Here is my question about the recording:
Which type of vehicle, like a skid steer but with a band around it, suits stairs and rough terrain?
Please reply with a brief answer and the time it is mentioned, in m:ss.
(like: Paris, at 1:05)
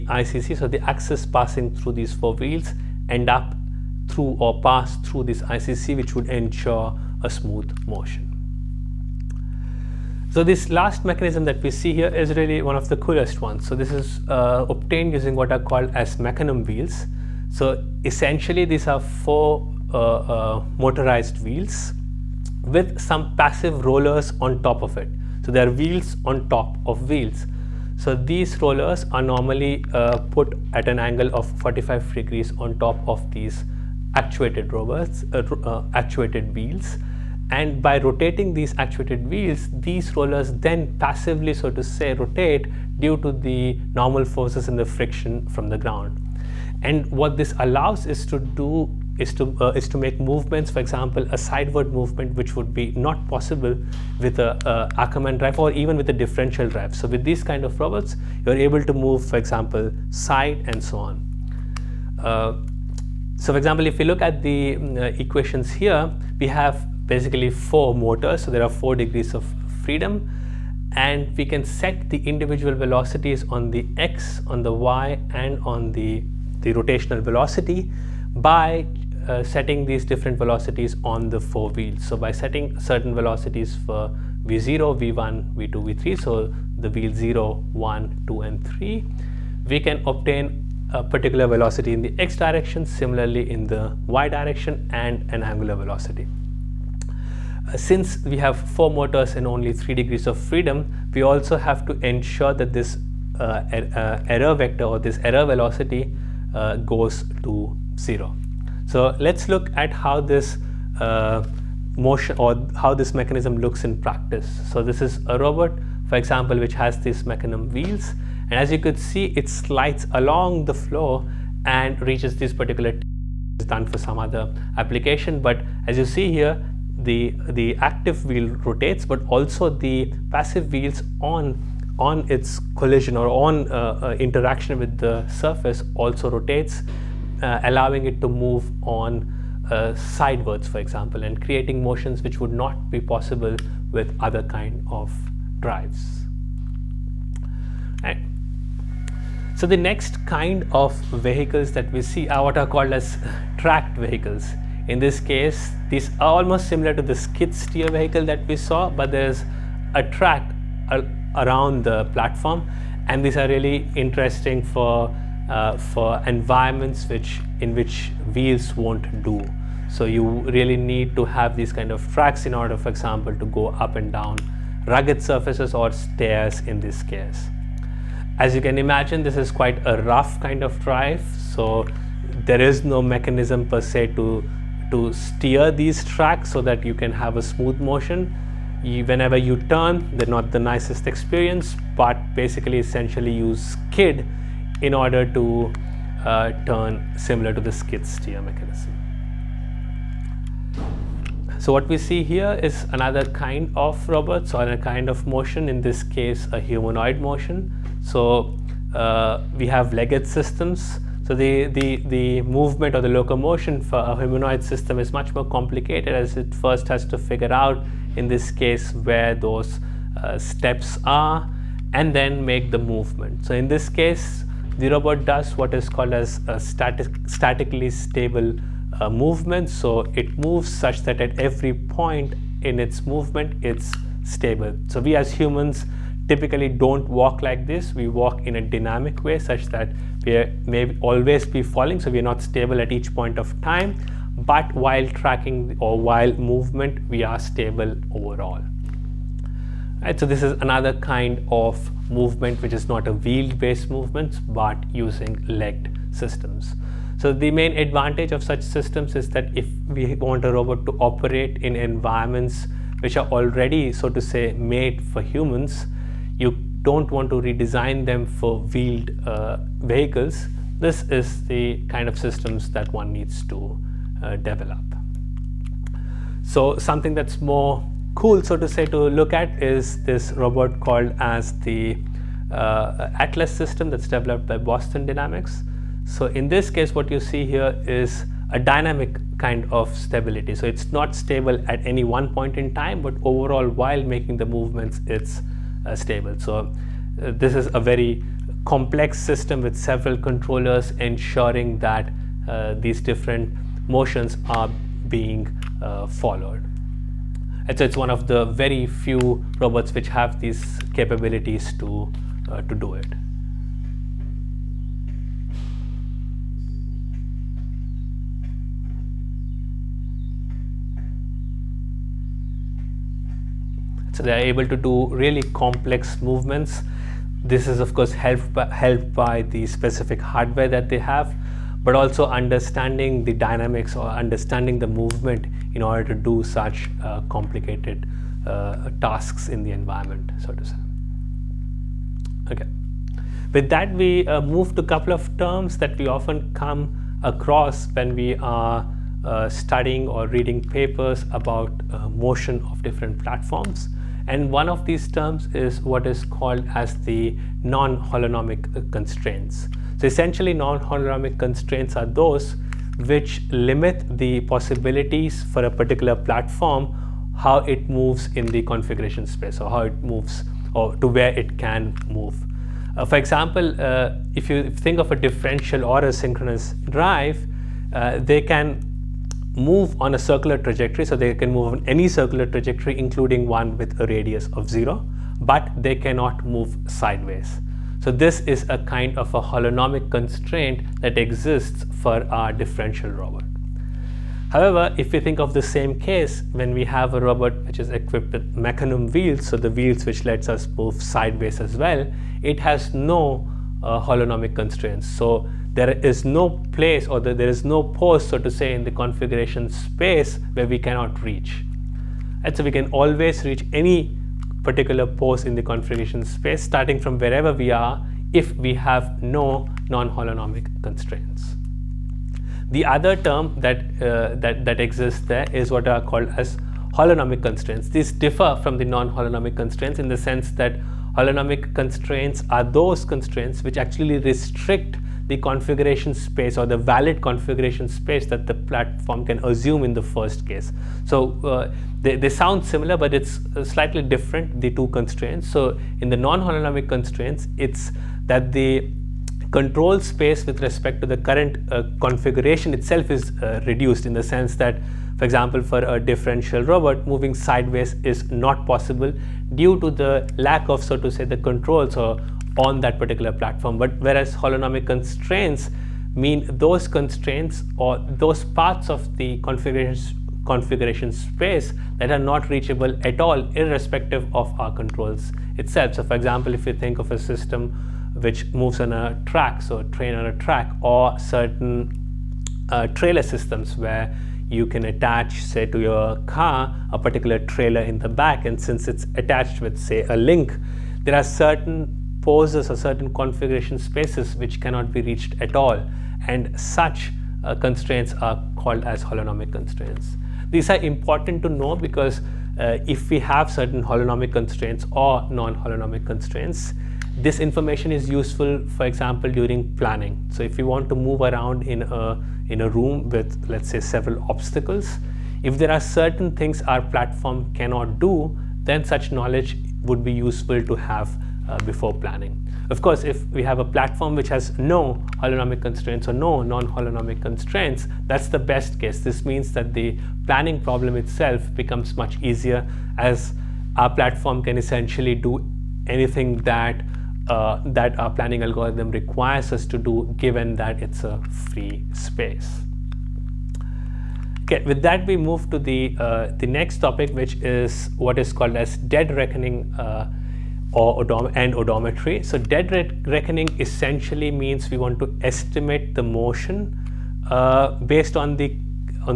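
Tracked vehicles, at 2:33.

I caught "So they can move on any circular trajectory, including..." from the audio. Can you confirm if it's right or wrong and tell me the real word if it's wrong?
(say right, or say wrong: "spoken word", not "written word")
right.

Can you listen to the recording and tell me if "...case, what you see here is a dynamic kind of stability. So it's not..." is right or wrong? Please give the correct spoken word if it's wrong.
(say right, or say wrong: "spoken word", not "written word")
right.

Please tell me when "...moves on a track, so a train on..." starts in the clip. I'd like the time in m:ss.
7:58.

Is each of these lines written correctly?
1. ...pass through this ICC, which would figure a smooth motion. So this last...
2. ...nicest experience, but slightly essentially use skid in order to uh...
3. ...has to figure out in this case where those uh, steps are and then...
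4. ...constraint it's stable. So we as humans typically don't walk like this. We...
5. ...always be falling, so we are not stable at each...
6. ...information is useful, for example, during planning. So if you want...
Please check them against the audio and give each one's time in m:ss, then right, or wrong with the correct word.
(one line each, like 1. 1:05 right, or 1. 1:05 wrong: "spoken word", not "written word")
1. 0:04 wrong: "ensure", not "figure"
2. 3:10 wrong: "basically", not "slightly"
3. 3:36 right
4. 3:53 wrong: "movement", not "constraint"
5. 4:01 right
6. 8:27 right.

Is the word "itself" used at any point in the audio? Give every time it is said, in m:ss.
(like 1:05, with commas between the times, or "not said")
7:32, 7:55, 8:50.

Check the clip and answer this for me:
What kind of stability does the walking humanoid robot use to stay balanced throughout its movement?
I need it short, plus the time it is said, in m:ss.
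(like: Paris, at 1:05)
Statically stable, at 3:47.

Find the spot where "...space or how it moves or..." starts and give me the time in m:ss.
6:09.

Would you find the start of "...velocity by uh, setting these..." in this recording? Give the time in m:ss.
1:17.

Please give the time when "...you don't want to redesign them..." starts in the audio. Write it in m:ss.
4:26.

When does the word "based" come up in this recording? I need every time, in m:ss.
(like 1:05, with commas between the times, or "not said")
4:13, 9:17.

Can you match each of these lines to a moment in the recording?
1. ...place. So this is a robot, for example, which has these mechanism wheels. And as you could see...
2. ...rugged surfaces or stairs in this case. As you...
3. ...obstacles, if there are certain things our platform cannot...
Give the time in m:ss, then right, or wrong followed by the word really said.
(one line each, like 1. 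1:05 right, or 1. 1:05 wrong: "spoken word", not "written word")
1. 1:53 wrong: "practice", not "place"
2. 2:54 right
3. 8:34 right.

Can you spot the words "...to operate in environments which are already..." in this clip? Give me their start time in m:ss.
4:20.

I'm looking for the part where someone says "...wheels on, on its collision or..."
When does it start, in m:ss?
2:10.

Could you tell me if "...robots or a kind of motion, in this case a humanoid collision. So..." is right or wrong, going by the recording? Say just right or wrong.
wrong.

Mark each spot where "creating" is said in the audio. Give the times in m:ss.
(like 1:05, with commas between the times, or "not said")
2:21.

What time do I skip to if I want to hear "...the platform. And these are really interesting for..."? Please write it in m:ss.
2:41.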